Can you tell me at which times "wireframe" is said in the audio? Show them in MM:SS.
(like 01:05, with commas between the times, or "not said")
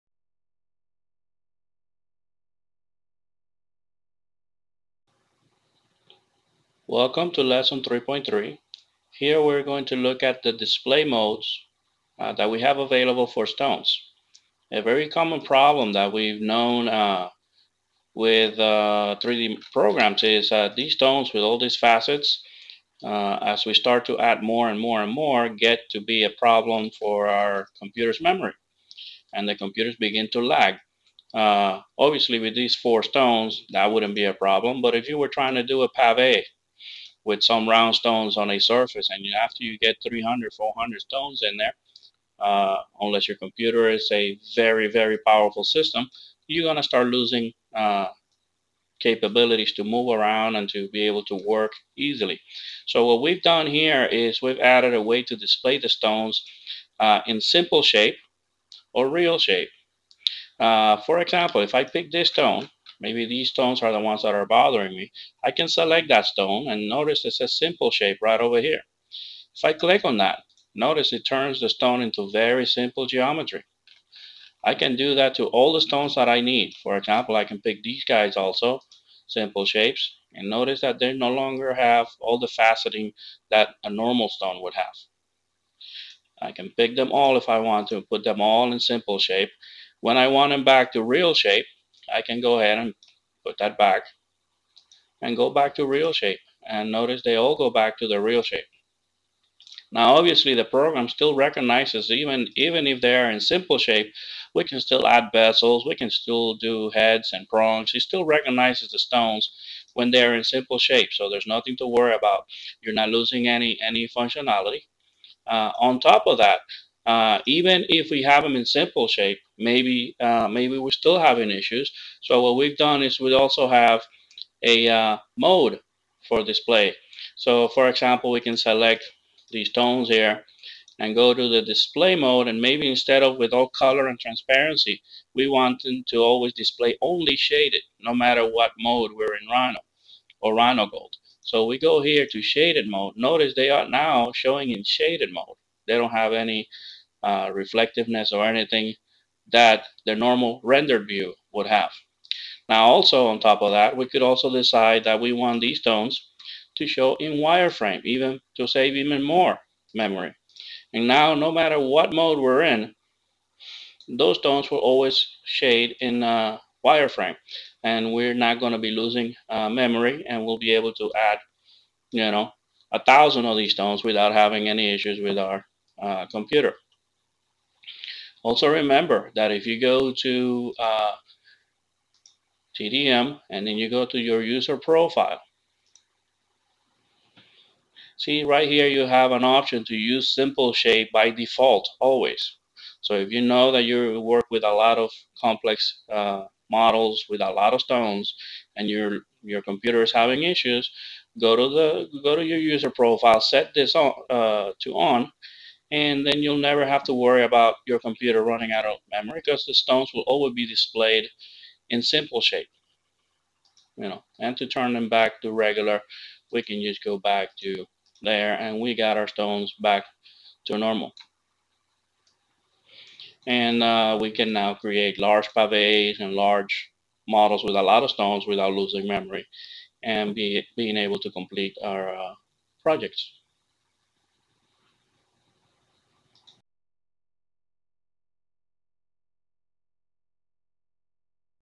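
02:37, 02:46.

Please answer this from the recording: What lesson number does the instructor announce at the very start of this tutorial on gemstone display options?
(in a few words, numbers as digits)
3.3.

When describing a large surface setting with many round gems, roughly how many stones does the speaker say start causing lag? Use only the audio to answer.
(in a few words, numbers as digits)
300, 400.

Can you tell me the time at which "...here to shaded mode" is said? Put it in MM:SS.
02:22.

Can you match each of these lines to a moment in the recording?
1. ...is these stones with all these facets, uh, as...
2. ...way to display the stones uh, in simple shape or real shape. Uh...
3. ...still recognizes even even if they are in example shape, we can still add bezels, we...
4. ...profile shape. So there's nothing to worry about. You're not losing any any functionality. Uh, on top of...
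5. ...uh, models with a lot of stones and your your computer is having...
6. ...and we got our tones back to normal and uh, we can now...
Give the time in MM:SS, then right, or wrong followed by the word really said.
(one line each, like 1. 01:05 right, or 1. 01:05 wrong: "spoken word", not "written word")
1. 00:20 right
2. 00:55 right
3. 01:41 wrong: "simple", not "example"
4. 01:50 wrong: "simple", not "profile"
5. 03:16 right
6. 03:38 wrong: "stones", not "tones".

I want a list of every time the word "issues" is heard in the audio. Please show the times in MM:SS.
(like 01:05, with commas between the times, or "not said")
02:01, 02:54, 03:20.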